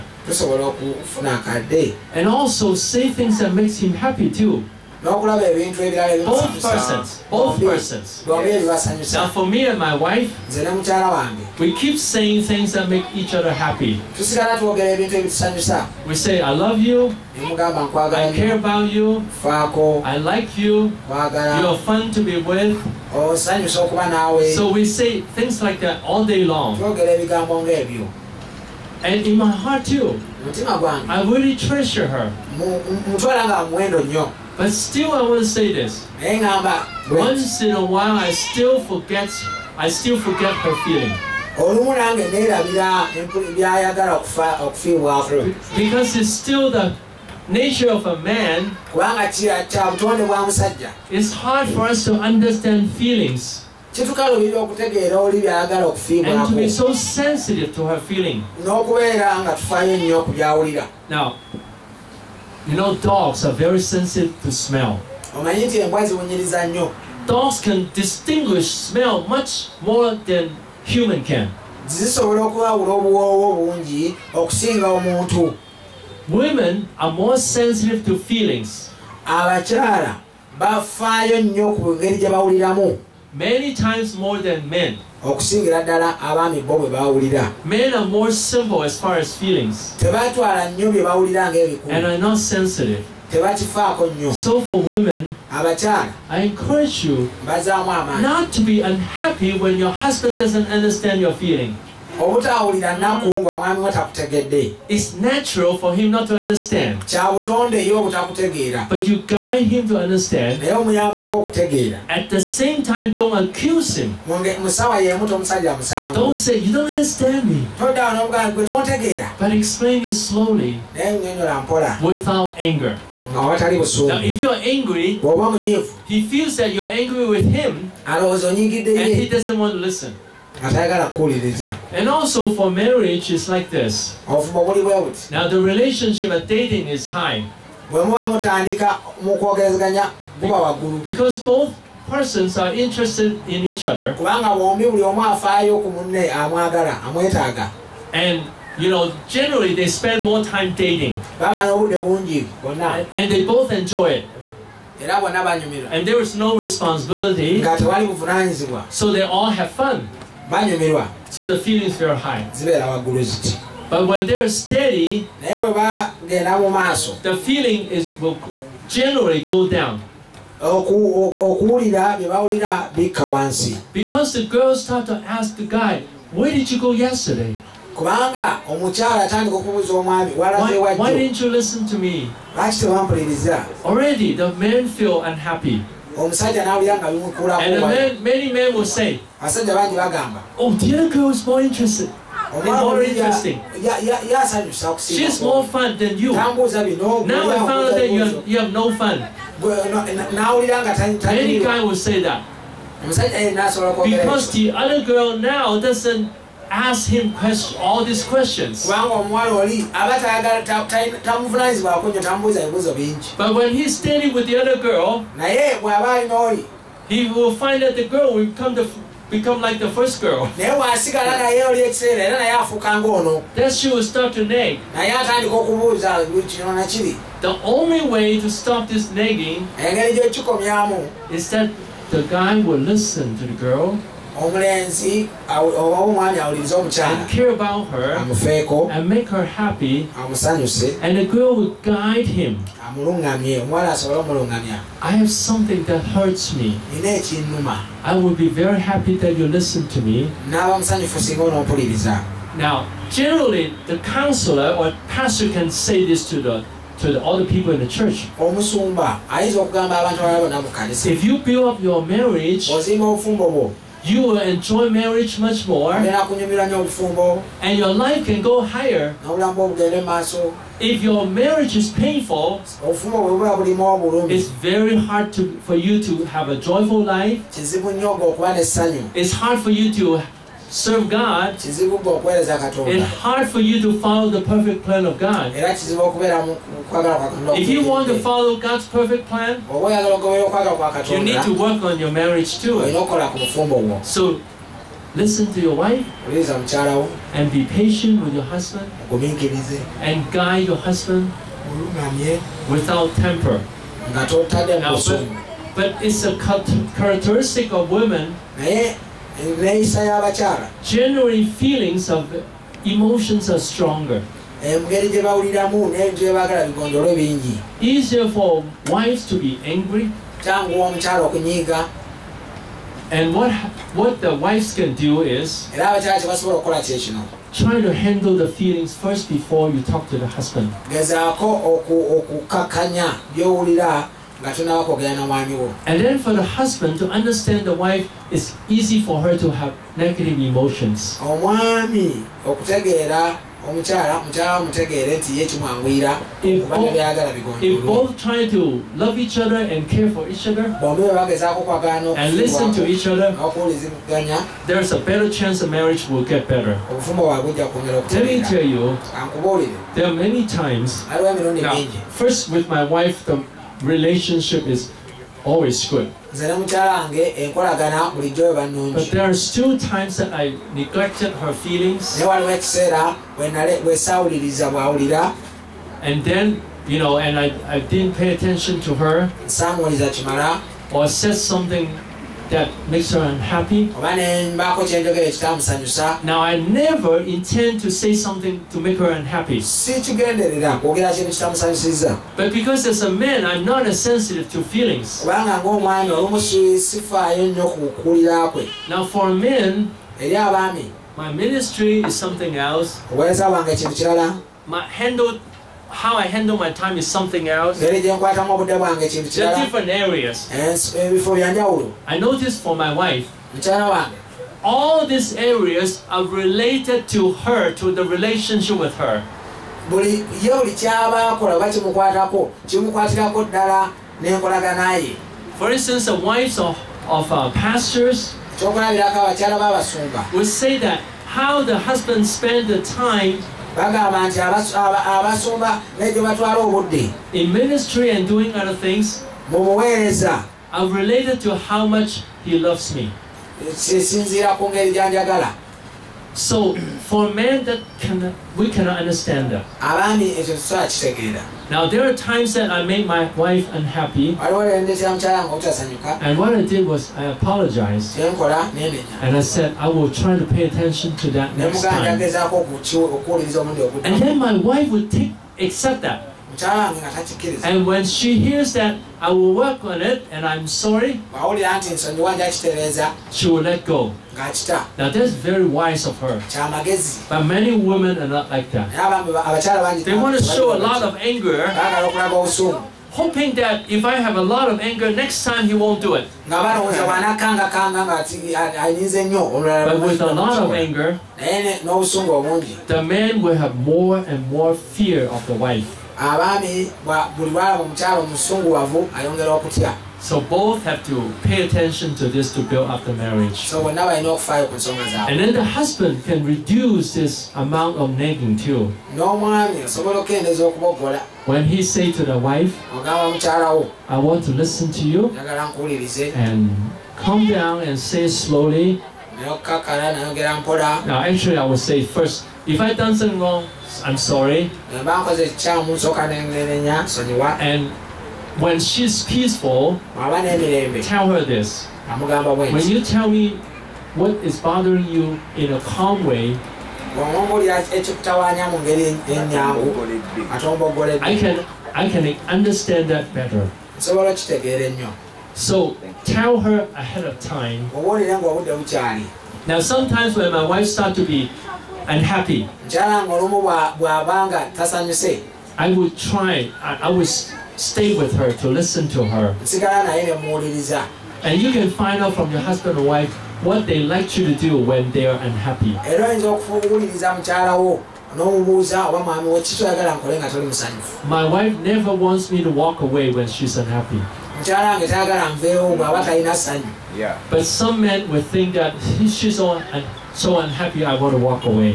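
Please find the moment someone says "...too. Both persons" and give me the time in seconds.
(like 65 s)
4 s.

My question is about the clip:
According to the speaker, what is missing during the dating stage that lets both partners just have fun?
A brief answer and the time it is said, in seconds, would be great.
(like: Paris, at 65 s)
no responsibility, at 156 s.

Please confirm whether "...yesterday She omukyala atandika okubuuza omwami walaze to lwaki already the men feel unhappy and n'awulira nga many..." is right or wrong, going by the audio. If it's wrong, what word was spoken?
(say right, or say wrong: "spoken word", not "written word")
wrong: "Why", not "She".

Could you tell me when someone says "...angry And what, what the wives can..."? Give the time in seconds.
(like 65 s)
319 s.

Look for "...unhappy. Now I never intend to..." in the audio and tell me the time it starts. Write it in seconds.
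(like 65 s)
383 s.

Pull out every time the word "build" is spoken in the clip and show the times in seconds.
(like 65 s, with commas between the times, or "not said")
261 s, 502 s.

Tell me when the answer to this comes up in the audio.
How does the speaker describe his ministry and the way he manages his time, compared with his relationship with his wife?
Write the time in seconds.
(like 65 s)
408 s.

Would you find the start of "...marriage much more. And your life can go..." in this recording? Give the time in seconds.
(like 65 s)
264 s.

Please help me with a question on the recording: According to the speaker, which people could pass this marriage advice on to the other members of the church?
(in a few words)
counselor or pastor.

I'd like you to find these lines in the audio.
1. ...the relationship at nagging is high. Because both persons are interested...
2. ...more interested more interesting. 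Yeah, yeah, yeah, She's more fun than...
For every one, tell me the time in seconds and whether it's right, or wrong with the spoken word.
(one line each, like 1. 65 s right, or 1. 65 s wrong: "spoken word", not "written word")
1. 135 s wrong: "dating", not "nagging"
2. 191 s right.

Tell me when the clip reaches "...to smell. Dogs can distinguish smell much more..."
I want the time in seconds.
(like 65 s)
64 s.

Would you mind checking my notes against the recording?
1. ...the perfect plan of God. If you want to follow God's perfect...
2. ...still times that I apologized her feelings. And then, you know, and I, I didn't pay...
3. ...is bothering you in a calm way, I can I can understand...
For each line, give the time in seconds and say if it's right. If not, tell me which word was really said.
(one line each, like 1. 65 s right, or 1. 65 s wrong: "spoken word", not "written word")
1. 284 s right
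2. 369 s wrong: "neglected", not "apologized"
3. 534 s right.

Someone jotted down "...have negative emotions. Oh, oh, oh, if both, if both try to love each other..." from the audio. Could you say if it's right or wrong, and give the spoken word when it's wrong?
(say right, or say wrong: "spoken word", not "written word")
right.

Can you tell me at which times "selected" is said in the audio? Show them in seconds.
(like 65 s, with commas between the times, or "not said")
not said.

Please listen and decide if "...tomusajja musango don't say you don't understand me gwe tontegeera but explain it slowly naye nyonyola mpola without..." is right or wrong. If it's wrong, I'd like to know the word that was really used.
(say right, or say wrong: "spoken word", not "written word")
right.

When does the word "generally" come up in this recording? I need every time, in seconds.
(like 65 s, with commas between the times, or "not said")
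149 s, 168 s, 253 s, 310 s.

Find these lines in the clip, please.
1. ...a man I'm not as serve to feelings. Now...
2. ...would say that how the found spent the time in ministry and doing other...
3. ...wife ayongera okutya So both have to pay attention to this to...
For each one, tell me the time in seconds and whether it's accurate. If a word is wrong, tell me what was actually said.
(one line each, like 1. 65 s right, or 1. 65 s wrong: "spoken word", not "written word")
1. 393 s wrong: "sensitive", not "serve"
2. 428 s wrong: "husband", not "found"
3. 495 s right.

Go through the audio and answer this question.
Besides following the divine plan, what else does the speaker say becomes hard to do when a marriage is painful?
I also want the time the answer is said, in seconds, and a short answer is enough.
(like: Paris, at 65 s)
serve God, at 280 s.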